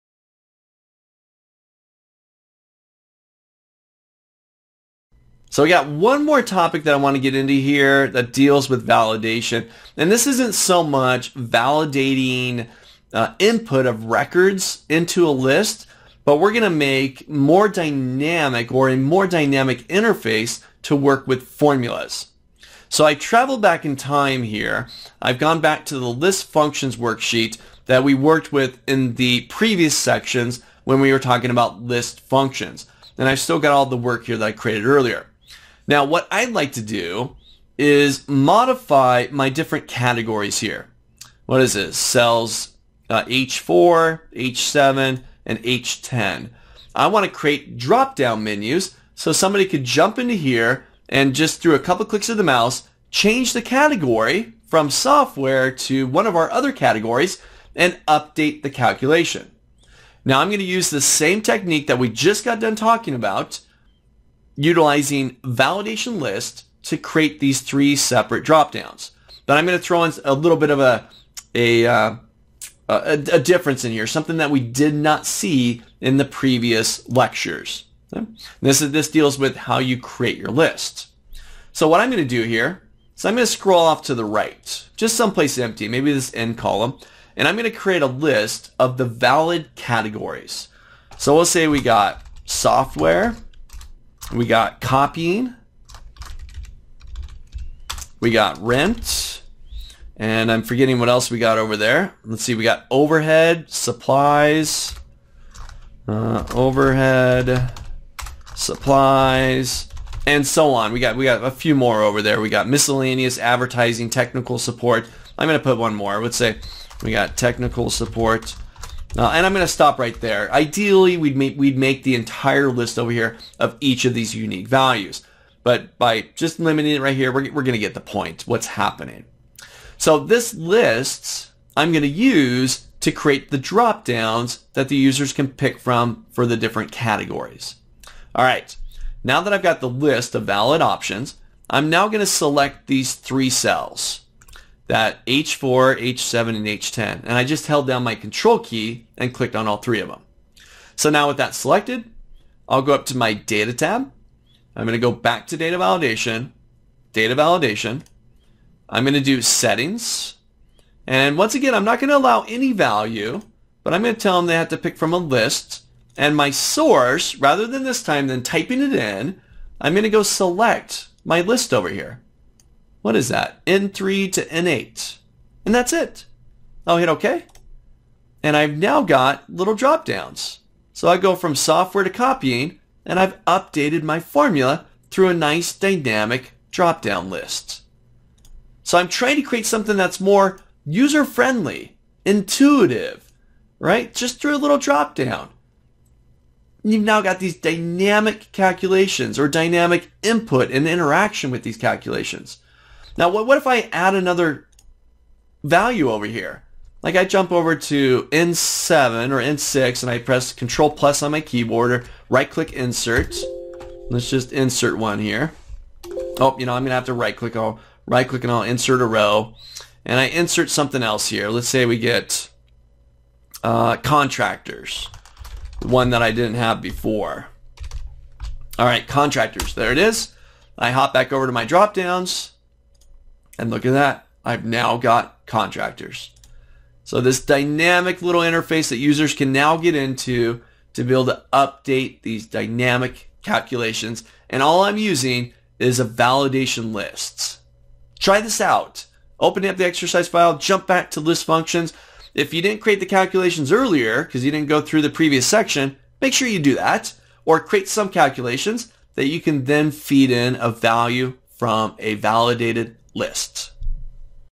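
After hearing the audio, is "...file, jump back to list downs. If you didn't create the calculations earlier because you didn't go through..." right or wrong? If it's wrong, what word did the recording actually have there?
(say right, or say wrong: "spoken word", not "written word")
wrong: "functions", not "downs".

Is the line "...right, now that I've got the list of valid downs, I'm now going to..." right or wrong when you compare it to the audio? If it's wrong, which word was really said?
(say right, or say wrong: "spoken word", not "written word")
wrong: "options", not "downs".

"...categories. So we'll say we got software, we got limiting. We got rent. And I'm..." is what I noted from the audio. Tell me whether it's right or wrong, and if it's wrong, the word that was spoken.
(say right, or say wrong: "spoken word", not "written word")
wrong: "copying", not "limiting".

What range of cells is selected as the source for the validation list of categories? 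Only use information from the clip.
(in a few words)
N3 to N8.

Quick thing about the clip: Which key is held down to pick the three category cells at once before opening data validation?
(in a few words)
control key.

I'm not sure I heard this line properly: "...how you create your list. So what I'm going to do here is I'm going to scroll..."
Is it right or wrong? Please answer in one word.
right.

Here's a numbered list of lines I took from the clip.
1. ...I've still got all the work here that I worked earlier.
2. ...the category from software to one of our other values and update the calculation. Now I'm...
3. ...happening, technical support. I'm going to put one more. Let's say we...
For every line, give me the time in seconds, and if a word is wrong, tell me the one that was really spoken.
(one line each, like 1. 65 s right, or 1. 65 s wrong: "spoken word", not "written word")
1. 33 s wrong: "created", not "worked"
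2. 53 s wrong: "categories", not "values"
3. 113 s wrong: "advertising", not "happening".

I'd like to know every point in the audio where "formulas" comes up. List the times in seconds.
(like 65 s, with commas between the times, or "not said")
21 s, 184 s.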